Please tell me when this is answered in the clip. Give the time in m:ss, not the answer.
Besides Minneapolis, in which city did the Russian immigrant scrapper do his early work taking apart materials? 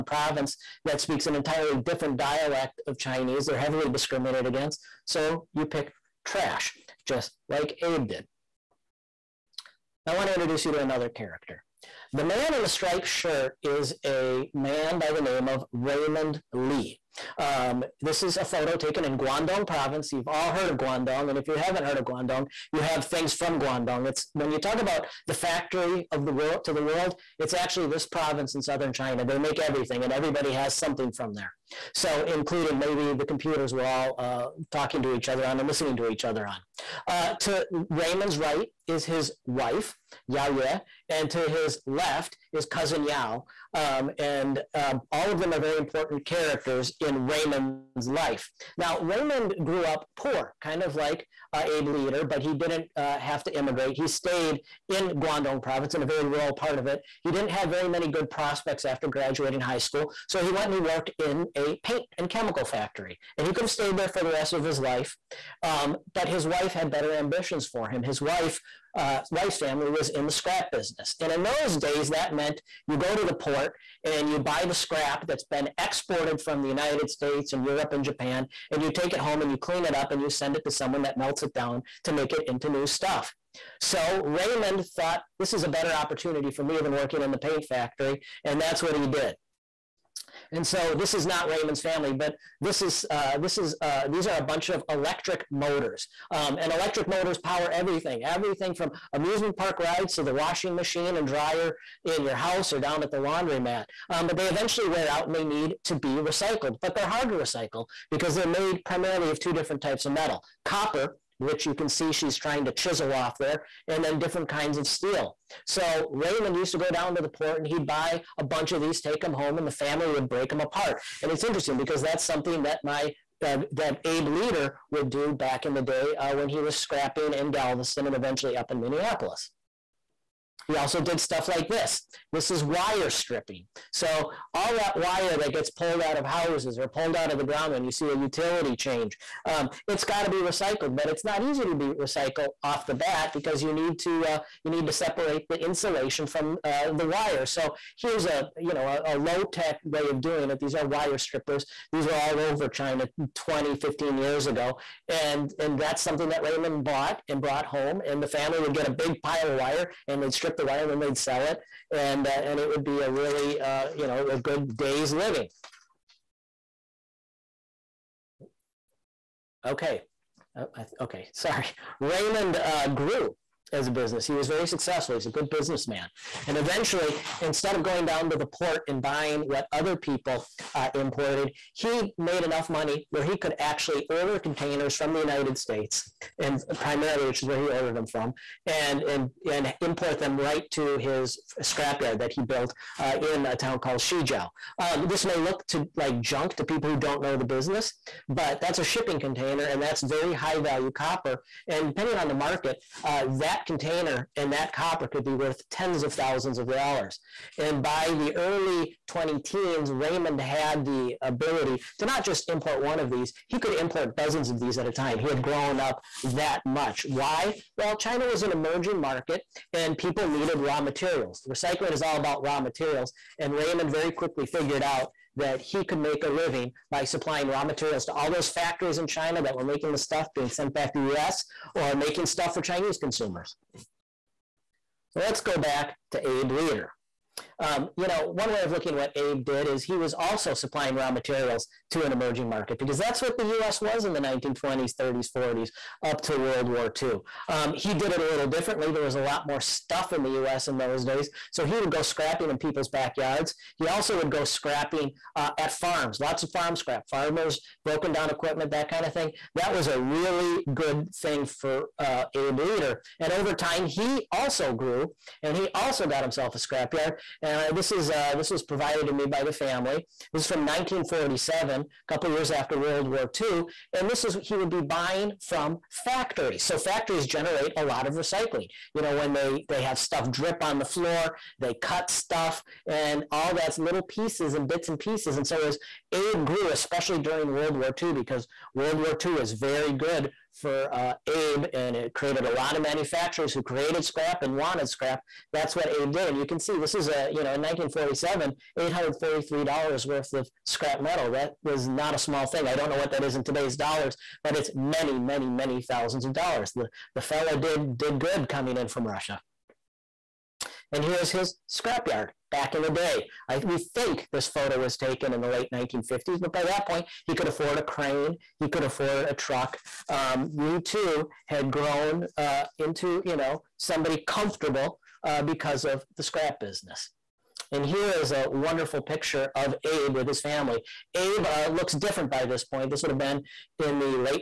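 2:07.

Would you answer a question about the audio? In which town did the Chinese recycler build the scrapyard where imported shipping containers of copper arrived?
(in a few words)
Shijiao.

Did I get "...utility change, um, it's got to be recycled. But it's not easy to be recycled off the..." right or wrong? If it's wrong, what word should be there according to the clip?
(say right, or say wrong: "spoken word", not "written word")
right.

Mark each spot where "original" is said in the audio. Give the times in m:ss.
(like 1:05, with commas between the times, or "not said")
not said.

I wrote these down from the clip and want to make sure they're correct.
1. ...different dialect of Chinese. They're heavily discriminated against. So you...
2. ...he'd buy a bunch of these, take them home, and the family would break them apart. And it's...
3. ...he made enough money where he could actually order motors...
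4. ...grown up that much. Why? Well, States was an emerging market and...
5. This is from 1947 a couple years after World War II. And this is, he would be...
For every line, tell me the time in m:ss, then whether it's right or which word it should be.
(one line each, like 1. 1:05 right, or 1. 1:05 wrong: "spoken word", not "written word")
1. 0:01 right
2. 1:57 right
3. 3:01 wrong: "containers", not "motors"
4. 3:35 wrong: "China", not "States"
5. 4:30 right.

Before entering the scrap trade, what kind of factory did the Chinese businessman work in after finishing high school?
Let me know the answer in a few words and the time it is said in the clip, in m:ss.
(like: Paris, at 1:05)
paint and chemical factory, at 1:01.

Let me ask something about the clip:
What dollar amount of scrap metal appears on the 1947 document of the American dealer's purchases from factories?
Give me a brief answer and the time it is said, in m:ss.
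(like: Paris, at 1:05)
$843, at 4:58.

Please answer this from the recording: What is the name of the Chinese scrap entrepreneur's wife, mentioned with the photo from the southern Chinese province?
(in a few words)
Yao Ye.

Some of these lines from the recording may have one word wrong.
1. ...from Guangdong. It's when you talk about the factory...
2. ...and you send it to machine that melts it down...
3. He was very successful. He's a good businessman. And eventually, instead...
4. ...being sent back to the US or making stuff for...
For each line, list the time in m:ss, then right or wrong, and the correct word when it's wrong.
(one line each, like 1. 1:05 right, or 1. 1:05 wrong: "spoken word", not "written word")
1. 0:23 right
2. 1:20 wrong: "someone", not "machine"
3. 2:54 right
4. 3:50 right.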